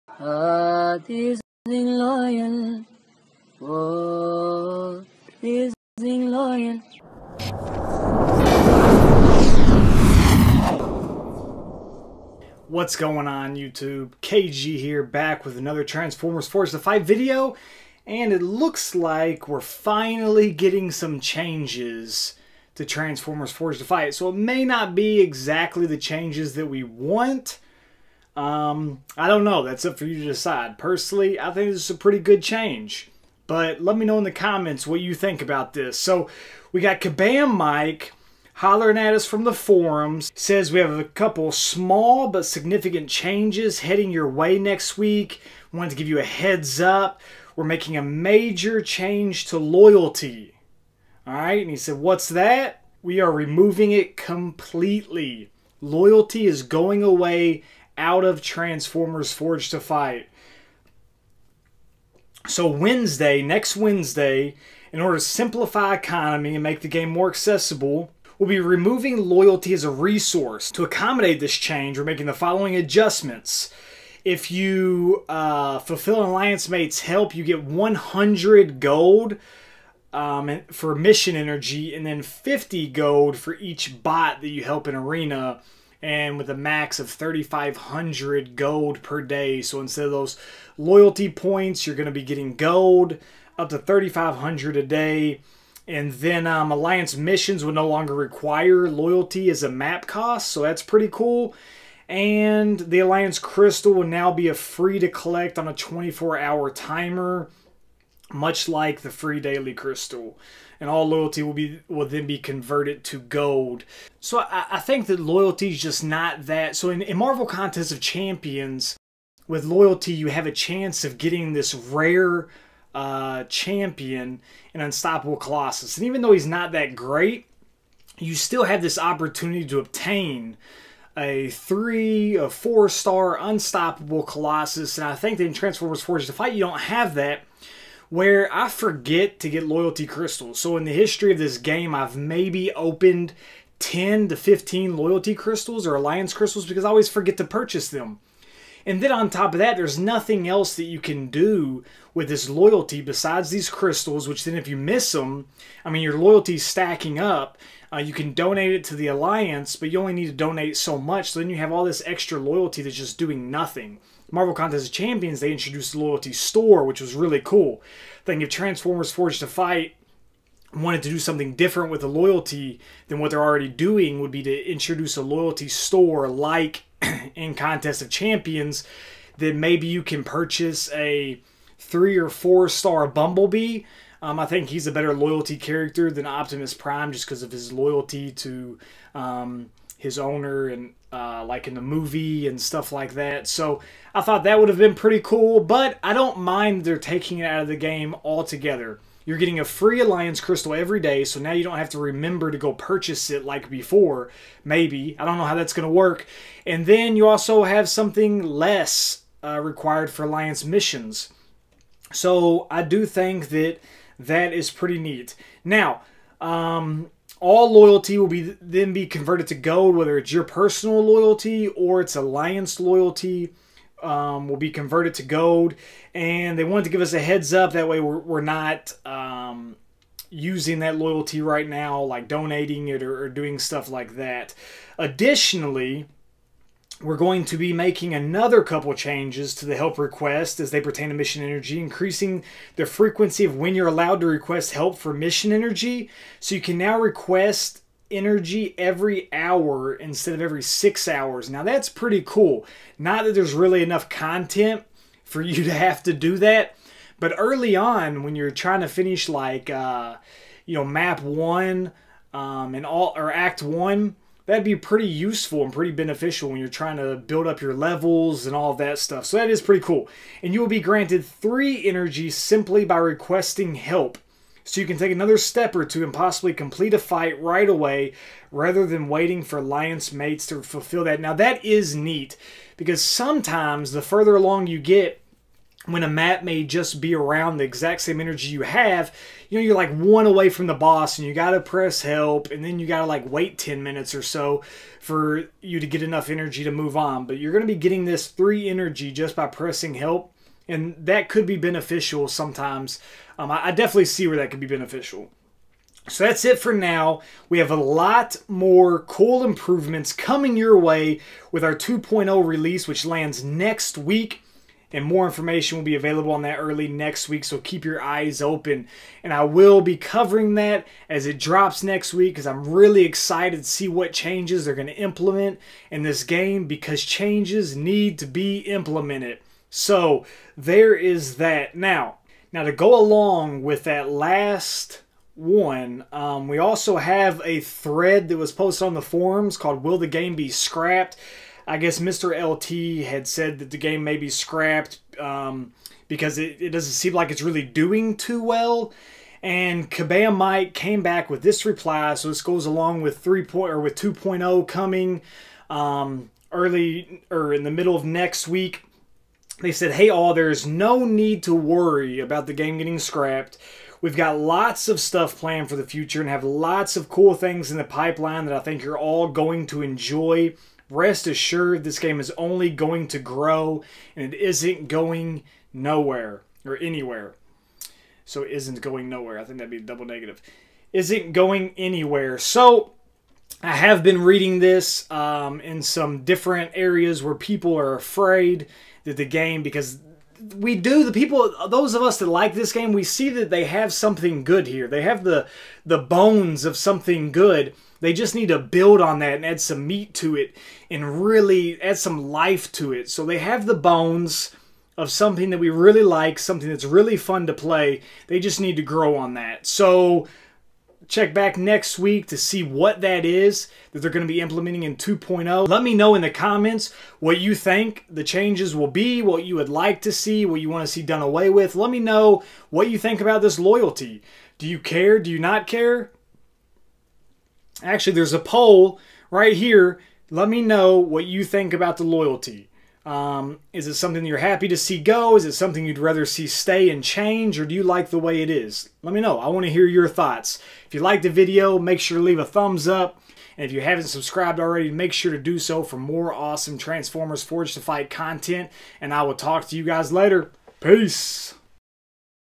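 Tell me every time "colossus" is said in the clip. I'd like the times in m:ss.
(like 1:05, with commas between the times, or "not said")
2:05, 2:14.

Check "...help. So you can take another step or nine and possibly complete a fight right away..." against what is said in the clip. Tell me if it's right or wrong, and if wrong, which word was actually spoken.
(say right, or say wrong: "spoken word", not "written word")
wrong: "two", not "nine".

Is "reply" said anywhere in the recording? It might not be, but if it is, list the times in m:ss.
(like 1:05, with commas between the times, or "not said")
5:51.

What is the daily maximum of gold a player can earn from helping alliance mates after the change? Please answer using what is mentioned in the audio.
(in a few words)
3,500.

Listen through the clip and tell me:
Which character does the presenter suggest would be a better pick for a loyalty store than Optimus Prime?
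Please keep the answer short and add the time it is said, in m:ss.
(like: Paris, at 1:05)
Bumblebee, at 3:03.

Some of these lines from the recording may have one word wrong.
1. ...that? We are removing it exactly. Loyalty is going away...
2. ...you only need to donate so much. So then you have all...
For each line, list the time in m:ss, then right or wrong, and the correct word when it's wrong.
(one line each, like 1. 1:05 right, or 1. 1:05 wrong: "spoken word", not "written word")
1. 0:52 wrong: "completely", not "exactly"
2. 2:39 right.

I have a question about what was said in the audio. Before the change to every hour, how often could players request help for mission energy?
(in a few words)
Every 6 hours.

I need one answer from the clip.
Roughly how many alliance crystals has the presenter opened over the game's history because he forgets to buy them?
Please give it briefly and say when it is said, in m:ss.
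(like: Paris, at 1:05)
10 to 15, at 2:23.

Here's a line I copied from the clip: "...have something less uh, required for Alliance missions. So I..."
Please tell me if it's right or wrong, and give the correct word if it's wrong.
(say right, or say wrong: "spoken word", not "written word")
right.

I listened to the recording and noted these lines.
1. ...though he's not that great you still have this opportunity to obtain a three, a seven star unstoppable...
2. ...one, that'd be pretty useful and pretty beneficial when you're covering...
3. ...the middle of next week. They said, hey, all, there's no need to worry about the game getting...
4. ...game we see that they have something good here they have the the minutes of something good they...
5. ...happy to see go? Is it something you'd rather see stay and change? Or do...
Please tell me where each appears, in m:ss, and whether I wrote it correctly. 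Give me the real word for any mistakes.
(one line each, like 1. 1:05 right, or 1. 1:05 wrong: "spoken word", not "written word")
1. 2:06 wrong: "four", not "seven"
2. 4:23 wrong: "trying", not "covering"
3. 5:57 right
4. 6:32 wrong: "bones", not "minutes"
5. 7:14 right.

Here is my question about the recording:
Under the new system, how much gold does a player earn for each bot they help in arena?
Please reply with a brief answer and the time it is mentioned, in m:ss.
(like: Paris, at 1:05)
50 gold, at 1:22.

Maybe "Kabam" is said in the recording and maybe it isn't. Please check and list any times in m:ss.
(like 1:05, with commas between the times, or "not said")
0:37, 5:49.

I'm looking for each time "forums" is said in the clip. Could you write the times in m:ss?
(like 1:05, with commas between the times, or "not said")
0:39, 5:39.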